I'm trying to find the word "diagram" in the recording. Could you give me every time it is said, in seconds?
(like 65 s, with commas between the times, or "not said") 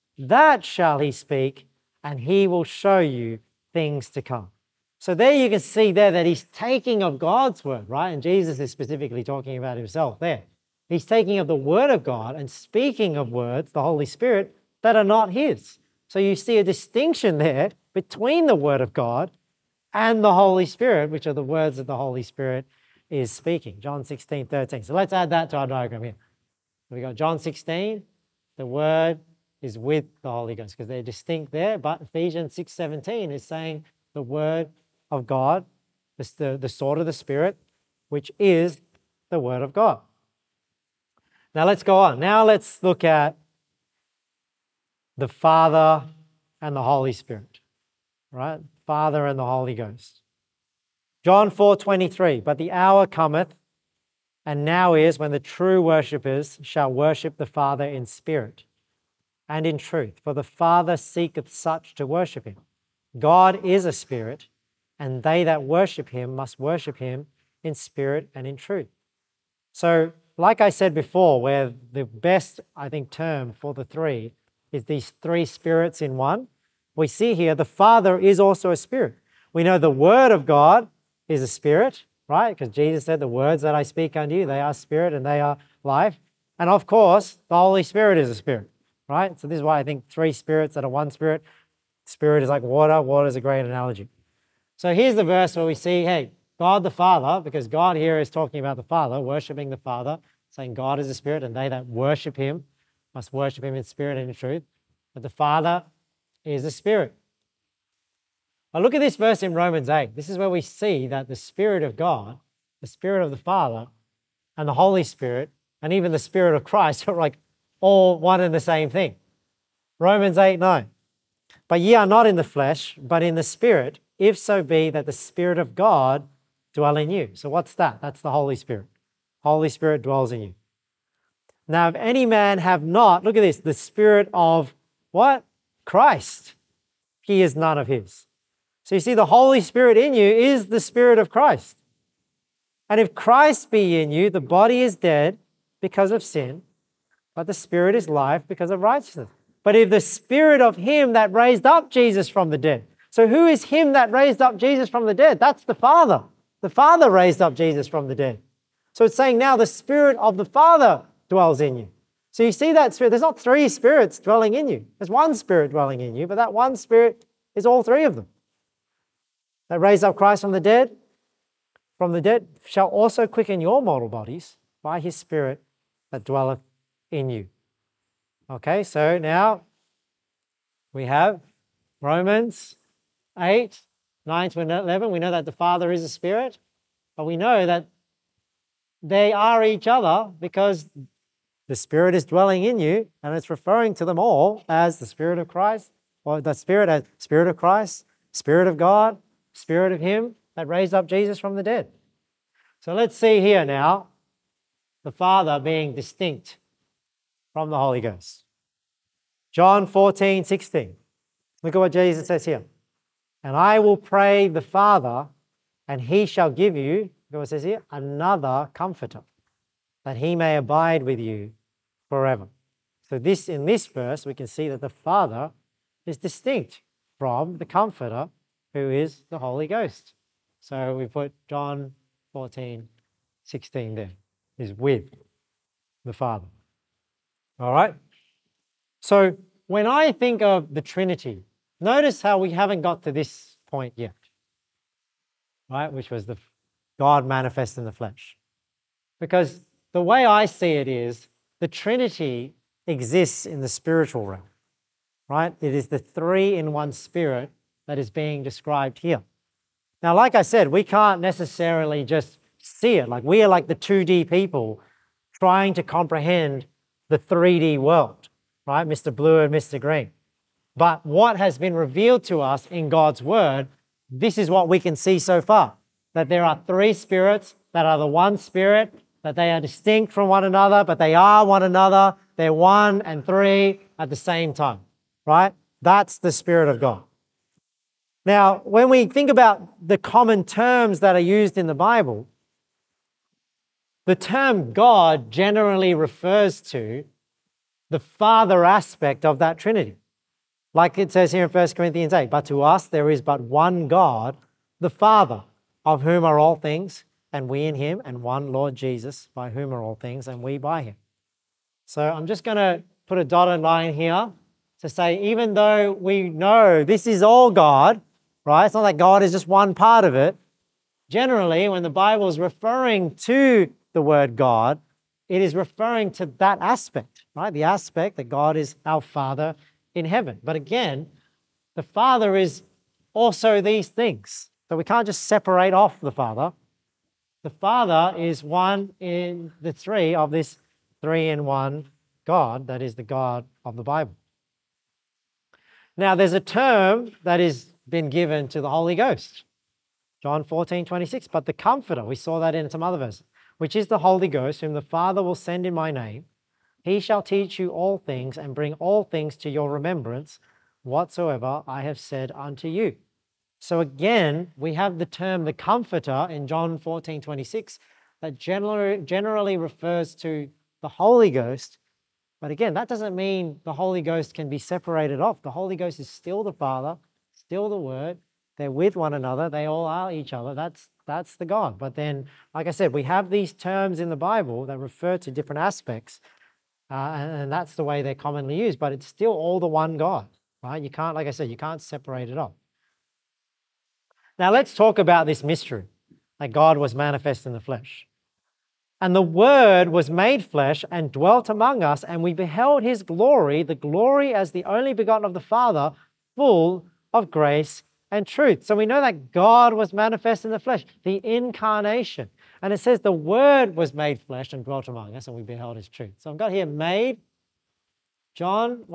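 25 s.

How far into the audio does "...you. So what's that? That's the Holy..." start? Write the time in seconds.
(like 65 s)
127 s.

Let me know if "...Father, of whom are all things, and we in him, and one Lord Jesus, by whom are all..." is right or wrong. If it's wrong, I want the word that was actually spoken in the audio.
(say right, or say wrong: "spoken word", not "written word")
right.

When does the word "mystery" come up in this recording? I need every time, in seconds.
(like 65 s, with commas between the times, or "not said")
395 s.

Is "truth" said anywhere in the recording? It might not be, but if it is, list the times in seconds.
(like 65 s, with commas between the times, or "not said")
59 s, 68 s, 104 s, 408 s, 415 s.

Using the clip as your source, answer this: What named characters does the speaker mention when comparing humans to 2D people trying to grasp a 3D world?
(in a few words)
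Mr. Blue and Mr. Green.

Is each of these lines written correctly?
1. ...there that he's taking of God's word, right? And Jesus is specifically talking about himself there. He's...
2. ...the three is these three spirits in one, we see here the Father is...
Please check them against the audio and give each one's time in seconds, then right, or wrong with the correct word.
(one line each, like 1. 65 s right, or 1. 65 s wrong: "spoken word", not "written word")
1. 5 s right
2. 73 s right.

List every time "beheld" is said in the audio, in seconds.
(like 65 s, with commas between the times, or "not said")
402 s, 415 s.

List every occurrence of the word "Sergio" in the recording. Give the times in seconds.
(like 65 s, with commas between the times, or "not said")
not said.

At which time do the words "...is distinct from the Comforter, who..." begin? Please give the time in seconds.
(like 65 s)
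226 s.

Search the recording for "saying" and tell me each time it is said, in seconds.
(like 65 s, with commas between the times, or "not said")
33 s, 100 s, 159 s.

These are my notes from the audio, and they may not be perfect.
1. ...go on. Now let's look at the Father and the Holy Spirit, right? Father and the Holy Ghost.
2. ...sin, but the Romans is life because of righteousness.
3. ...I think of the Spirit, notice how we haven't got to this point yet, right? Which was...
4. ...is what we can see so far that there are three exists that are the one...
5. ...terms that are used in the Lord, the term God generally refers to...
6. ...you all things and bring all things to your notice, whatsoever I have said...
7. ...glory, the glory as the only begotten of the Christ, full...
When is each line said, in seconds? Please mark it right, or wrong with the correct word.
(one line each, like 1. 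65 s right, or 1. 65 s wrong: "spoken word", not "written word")
1. 41 s right
2. 146 s wrong: "Spirit", not "Romans"
3. 239 s wrong: "Trinity", not "Spirit"
4. 274 s wrong: "spirits", not "exists"
5. 290 s wrong: "Bible", not "Lord"
6. 357 s wrong: "remembrance", not "notice"
7. 403 s wrong: "Father", not "Christ".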